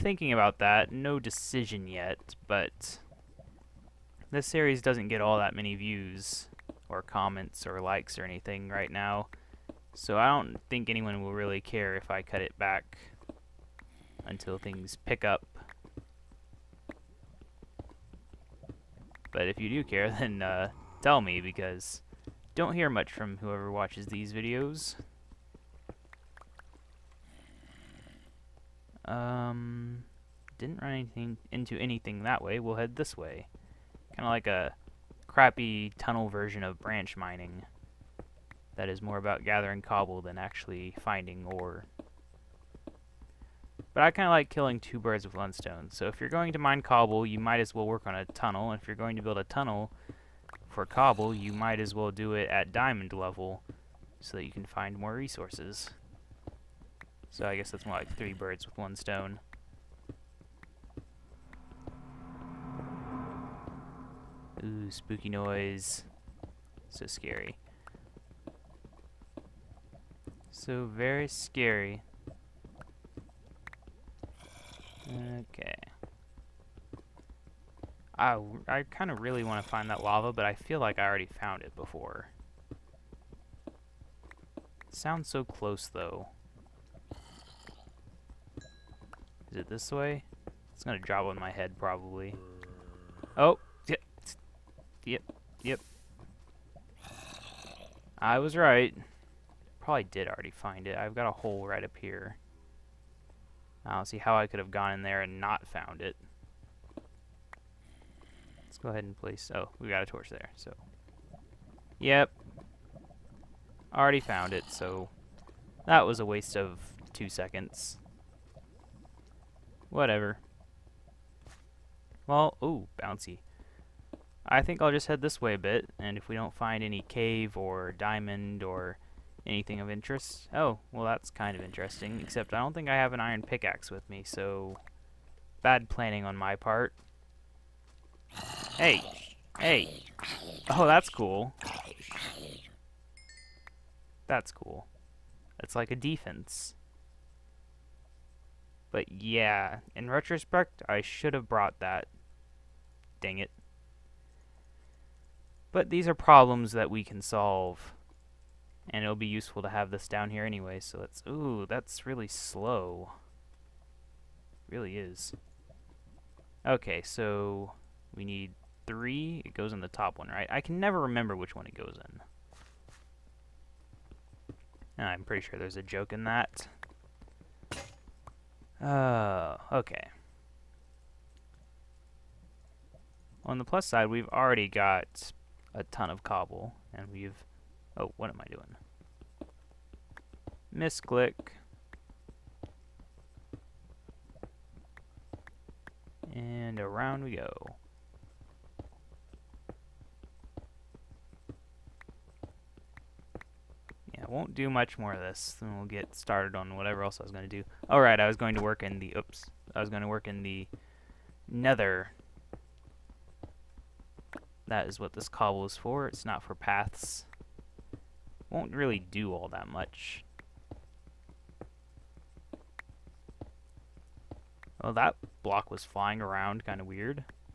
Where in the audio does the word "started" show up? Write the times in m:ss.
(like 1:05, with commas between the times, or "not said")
3:26.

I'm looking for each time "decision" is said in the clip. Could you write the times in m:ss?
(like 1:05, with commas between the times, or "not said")
0:01.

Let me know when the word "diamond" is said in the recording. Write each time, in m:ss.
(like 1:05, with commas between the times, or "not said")
0:52, 2:07.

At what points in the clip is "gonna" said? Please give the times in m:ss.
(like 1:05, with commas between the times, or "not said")
1:30.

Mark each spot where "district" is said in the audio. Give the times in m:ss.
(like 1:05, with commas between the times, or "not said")
not said.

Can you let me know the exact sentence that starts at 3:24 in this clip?
I won't do much more of this.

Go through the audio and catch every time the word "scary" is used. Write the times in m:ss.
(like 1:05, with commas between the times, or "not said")
1:07, 1:11.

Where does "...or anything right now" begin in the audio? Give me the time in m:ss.
0:08.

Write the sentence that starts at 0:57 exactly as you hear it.
So I guess that's more like three birds with one stone.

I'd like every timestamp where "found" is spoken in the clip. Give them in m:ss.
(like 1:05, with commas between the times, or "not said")
1:21, 1:45, 1:54.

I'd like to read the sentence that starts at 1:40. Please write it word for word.
I've got a hole right up here.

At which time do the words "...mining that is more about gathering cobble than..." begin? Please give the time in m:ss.
0:37.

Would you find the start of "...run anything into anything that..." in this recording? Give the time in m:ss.
0:30.